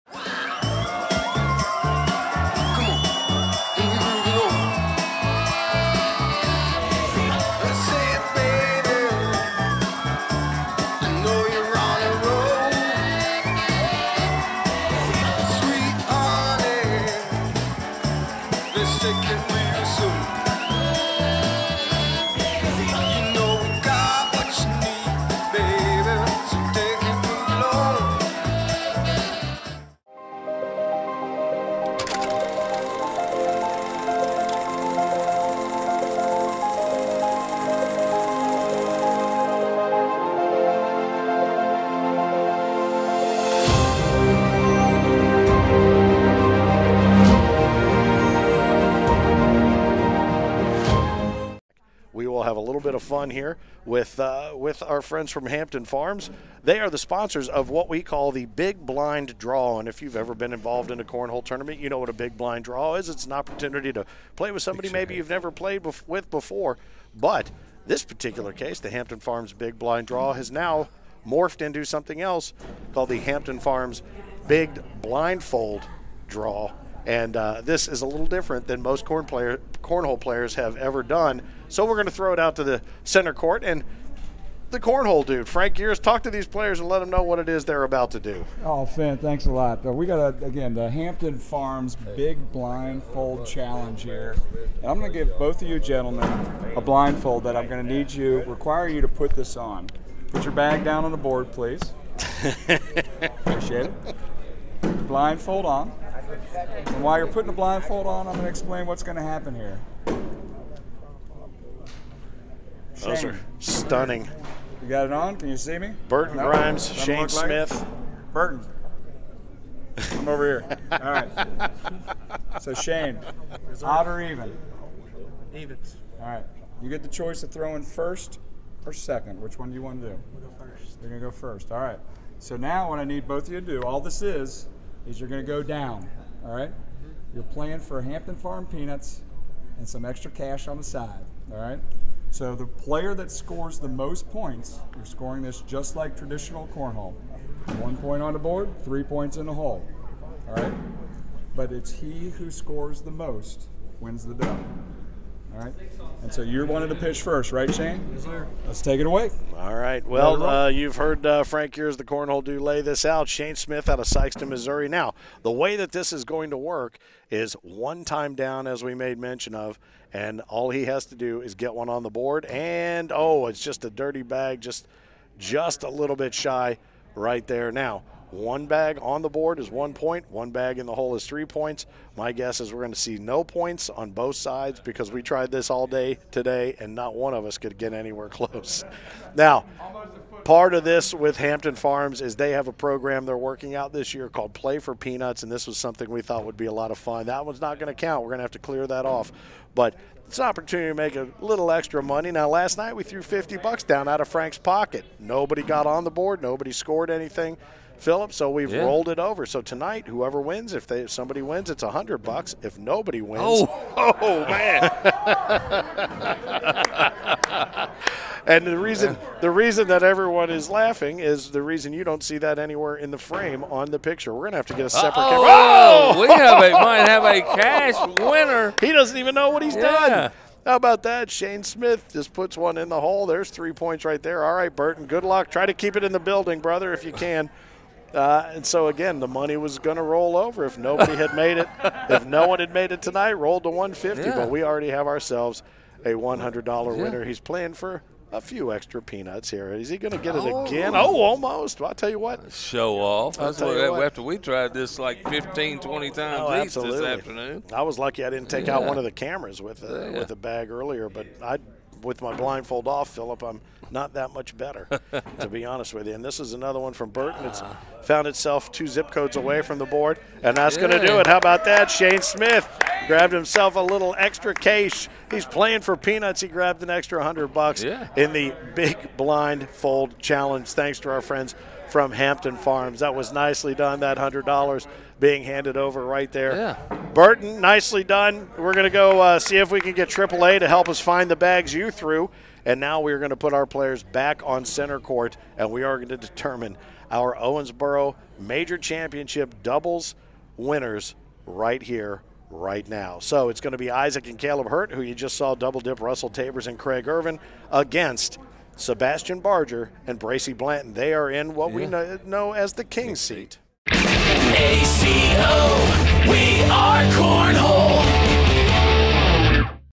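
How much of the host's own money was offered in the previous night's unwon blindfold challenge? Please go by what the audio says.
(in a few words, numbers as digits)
$50.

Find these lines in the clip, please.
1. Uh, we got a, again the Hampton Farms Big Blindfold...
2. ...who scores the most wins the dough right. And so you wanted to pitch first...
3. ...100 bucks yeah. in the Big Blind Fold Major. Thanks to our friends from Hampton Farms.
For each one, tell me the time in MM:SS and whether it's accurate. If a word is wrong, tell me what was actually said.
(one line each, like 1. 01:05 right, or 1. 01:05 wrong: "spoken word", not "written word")
1. 01:29 right
2. 02:32 right
3. 04:37 wrong: "Challenge", not "Major".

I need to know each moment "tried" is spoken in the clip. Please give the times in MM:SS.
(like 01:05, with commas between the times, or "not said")
03:05, 04:14.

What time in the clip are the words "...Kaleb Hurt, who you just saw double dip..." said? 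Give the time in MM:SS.
05:04.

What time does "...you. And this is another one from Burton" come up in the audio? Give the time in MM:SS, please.
04:26.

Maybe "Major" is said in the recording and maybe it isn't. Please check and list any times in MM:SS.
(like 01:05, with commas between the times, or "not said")
04:58.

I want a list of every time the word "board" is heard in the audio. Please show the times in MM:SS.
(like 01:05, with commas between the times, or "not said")
01:41, 02:28, 02:52, 02:59, 03:26, 04:29.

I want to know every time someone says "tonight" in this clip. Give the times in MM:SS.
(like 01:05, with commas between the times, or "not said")
03:29, 04:03.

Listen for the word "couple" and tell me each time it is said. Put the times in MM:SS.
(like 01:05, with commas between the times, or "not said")
not said.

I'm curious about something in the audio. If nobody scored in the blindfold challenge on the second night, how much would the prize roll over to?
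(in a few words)
$150.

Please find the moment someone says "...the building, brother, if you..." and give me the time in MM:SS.
03:56.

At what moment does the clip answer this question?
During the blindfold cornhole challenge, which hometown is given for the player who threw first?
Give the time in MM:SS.
02:44.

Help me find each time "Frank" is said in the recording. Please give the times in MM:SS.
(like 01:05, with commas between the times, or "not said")
01:25, 02:41, 03:24.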